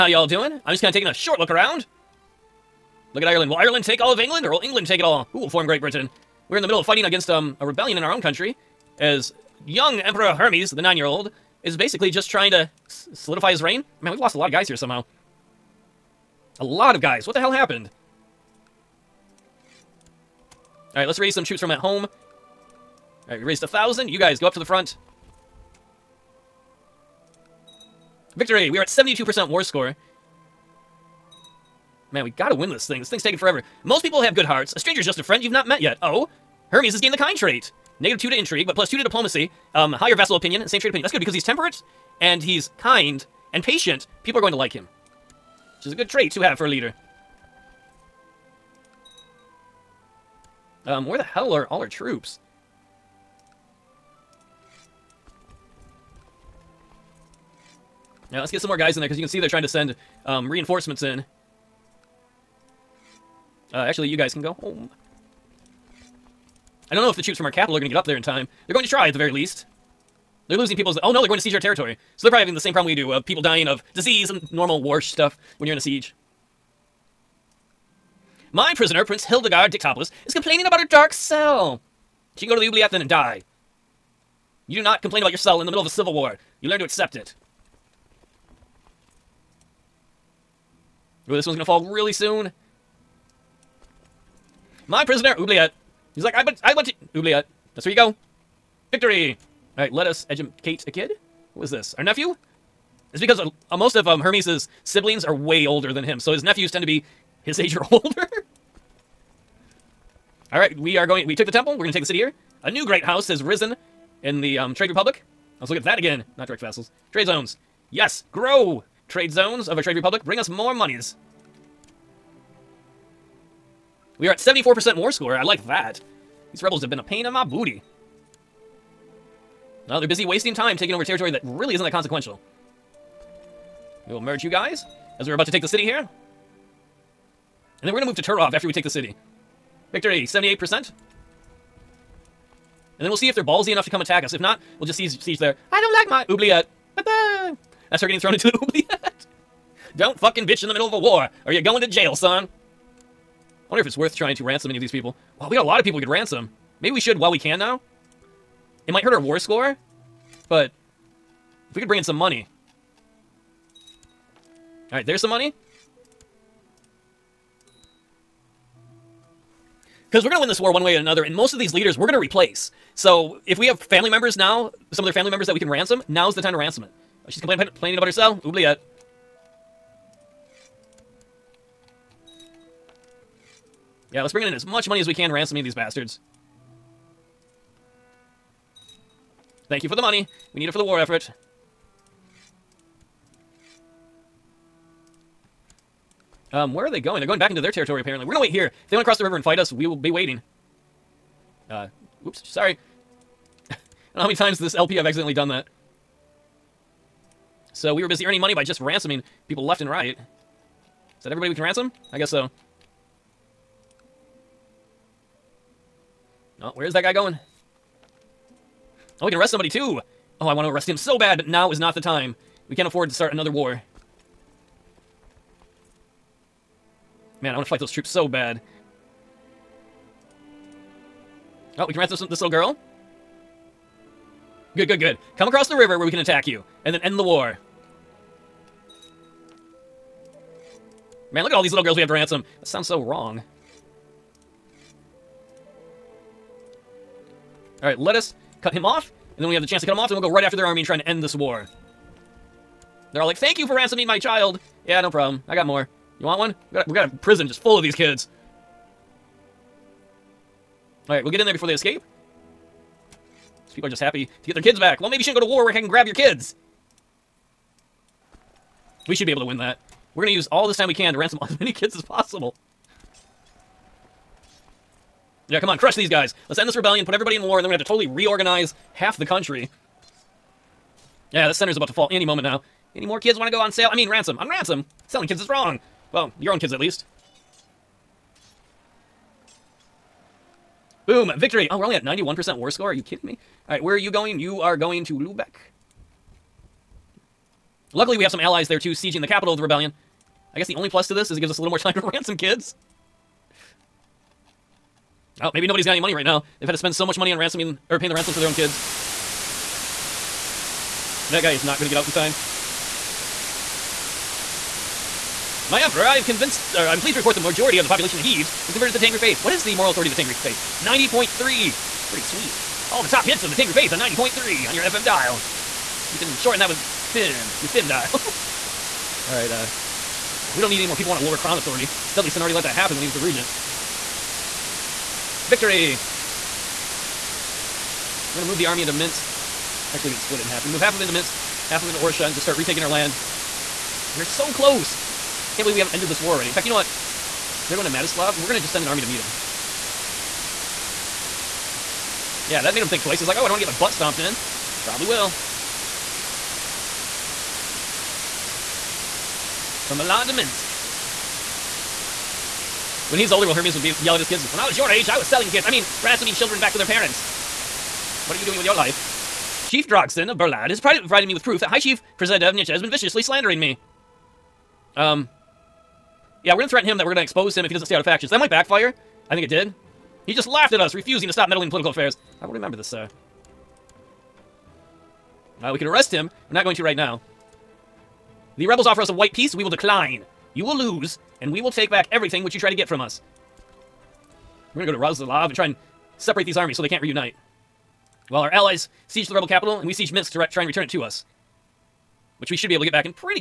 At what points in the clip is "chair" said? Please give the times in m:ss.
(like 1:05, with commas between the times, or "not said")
not said.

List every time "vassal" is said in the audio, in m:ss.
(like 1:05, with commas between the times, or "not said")
0:40, 1:56.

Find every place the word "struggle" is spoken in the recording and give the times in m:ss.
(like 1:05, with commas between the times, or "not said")
not said.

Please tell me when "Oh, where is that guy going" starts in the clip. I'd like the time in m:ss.
3:36.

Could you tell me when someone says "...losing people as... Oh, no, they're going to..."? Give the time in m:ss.
1:10.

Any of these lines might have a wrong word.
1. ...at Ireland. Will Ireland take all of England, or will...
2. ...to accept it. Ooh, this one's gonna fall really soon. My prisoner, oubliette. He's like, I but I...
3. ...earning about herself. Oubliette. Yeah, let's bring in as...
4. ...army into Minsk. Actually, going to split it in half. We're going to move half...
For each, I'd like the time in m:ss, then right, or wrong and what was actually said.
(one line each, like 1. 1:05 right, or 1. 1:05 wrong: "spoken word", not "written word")
1. 0:03 right
2. 1:26 right
3. 2:57 wrong: "complaining", not "earning"
4. 5:38 right.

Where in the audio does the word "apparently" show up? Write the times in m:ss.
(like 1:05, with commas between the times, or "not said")
3:18.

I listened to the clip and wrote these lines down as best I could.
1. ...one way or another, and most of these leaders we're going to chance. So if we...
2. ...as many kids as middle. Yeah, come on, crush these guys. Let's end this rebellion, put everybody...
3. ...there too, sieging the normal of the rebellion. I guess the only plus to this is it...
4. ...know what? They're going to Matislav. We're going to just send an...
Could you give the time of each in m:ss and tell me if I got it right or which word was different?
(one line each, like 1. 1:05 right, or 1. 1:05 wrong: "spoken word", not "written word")
1. 2:50 wrong: "replace", not "chance"
2. 4:31 wrong: "possible", not "middle"
3. 4:58 wrong: "capital", not "normal"
4. 5:46 right.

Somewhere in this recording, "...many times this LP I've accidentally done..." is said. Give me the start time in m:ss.
3:24.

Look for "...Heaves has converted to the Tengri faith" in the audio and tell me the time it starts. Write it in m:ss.
5:18.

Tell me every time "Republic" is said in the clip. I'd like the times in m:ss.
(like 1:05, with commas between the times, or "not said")
1:54, 1:59.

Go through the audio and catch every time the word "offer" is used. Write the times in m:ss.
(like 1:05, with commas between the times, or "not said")
6:28.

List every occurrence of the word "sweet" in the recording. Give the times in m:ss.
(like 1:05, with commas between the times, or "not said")
5:22.